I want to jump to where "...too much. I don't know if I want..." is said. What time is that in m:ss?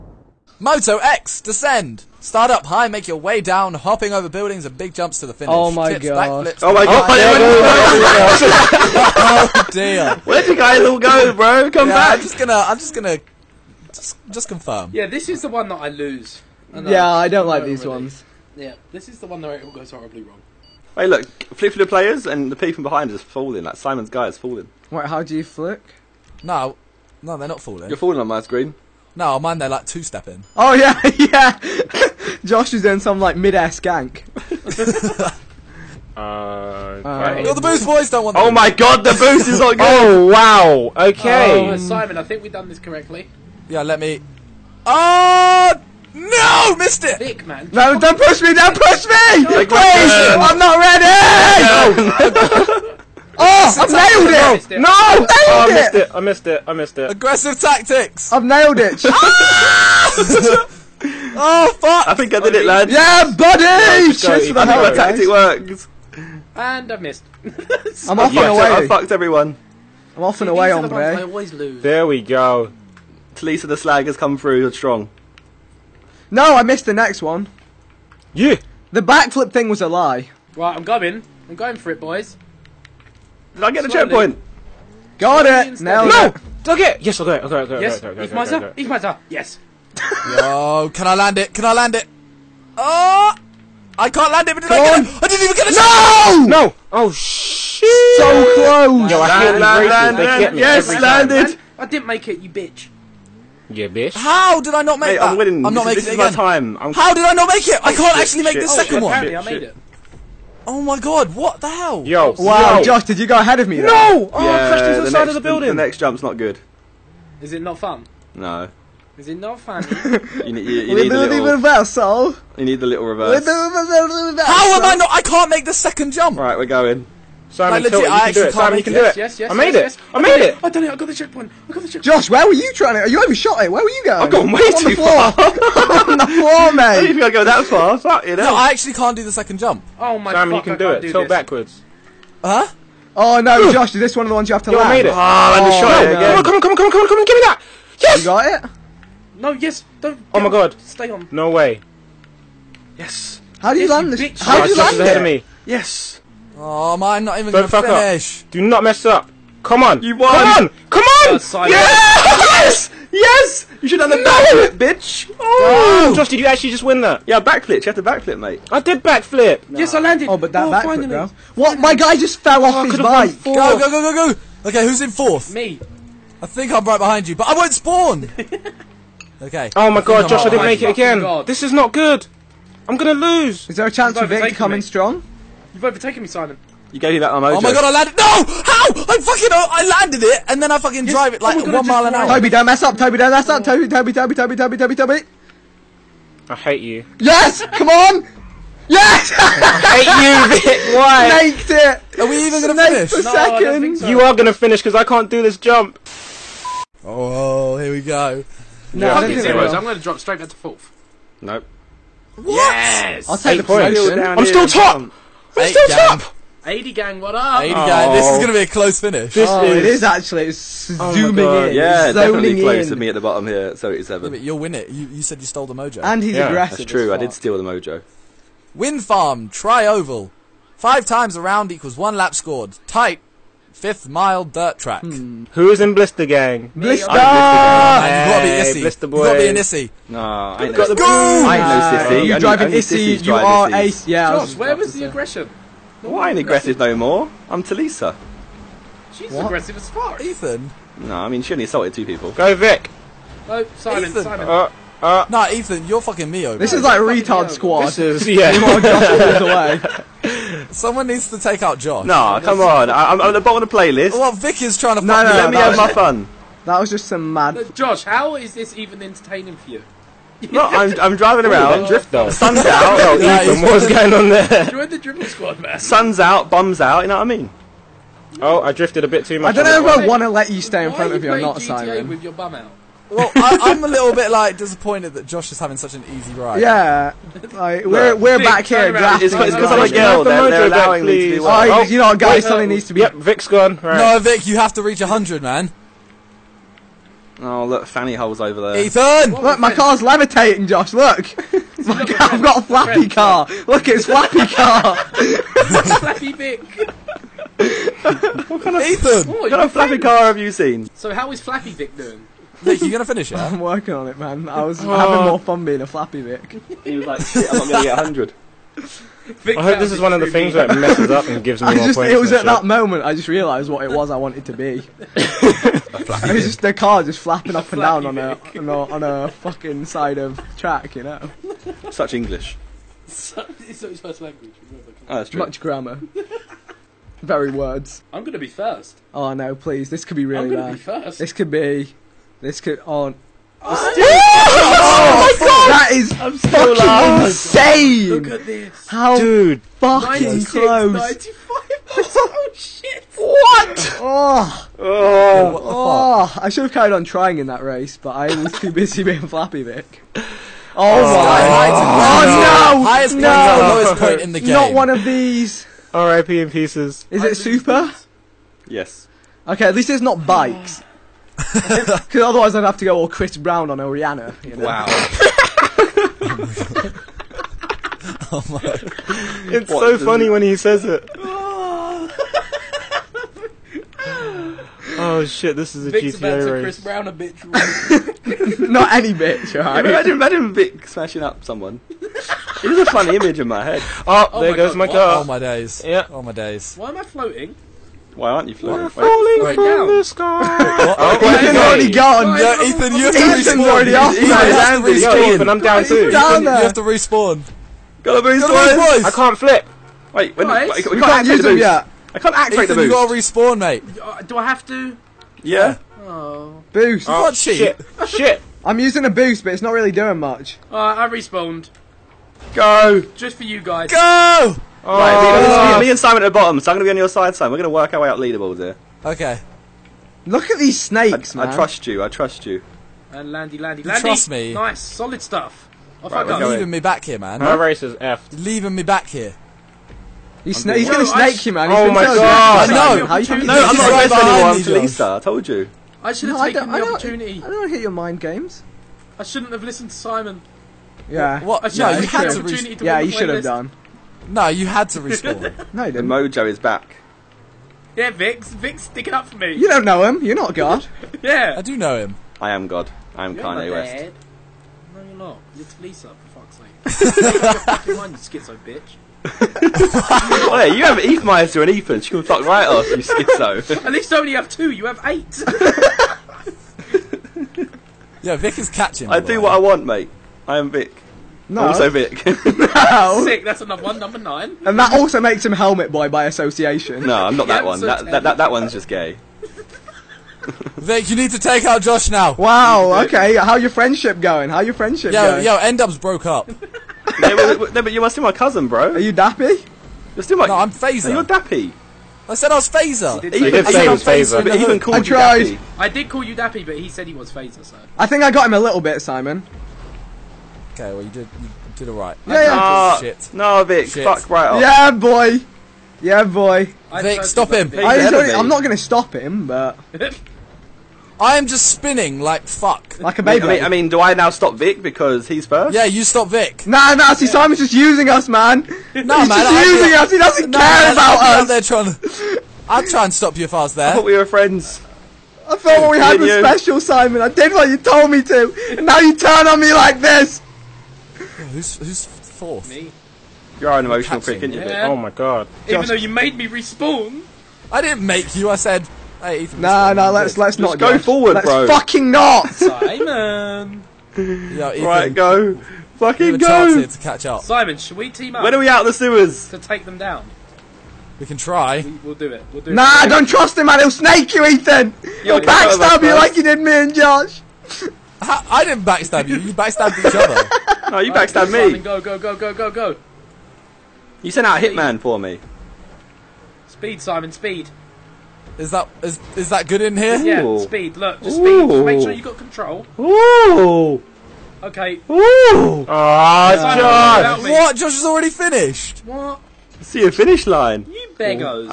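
4:39.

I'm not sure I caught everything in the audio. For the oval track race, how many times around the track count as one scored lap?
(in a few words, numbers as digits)
5.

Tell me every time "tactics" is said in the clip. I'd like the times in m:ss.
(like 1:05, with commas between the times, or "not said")
0:57, 1:04.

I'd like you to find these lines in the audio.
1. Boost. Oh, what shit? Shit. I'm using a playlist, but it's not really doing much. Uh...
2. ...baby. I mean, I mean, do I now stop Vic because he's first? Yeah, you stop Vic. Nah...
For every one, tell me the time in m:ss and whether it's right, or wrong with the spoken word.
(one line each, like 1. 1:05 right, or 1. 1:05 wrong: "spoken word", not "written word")
1. 6:56 wrong: "boost", not "playlist"
2. 8:43 right.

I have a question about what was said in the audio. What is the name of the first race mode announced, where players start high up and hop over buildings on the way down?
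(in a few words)
Moto X.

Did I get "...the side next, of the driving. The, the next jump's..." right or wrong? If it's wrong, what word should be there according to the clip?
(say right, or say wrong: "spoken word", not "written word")
wrong: "building", not "driving".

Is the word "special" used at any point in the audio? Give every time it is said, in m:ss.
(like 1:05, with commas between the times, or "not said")
8:56.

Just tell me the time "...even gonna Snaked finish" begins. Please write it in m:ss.
3:22.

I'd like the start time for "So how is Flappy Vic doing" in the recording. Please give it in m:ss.
5:10.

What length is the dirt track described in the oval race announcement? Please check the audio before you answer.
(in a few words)
fifth mile.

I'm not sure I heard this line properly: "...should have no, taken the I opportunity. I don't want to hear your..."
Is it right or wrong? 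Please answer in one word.
right.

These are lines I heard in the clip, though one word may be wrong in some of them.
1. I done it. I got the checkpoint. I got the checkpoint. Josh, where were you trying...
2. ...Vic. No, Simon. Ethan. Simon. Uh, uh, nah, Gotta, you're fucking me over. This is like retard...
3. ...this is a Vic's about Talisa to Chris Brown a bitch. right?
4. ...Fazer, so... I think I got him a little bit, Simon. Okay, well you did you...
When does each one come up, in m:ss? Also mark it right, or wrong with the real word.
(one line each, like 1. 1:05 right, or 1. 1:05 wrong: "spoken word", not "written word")
1. 2:10 right
2. 4:12 wrong: "Ethan", not "Gotta"
3. 6:25 wrong: "GTA", not "Talisa"
4. 8:27 right.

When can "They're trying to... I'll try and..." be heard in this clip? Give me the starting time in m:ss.
8:51.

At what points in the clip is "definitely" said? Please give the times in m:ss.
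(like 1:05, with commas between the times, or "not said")
3:42.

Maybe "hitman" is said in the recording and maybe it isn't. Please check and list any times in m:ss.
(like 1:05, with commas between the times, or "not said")
9:34.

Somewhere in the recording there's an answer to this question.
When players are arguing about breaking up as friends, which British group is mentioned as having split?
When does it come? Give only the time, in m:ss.
8:15.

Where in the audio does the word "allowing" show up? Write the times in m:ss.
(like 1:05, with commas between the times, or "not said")
4:50.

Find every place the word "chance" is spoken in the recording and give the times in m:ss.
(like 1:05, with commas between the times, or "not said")
3:03.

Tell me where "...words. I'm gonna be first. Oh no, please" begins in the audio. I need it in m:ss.
5:37.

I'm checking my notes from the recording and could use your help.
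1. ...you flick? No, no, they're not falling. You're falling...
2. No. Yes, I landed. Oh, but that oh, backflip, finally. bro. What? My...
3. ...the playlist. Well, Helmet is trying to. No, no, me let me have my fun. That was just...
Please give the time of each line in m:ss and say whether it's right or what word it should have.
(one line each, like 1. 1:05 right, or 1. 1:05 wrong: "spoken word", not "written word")
1. 0:25 right
2. 2:49 right
3. 4:23 wrong: "Vic", not "Helmet".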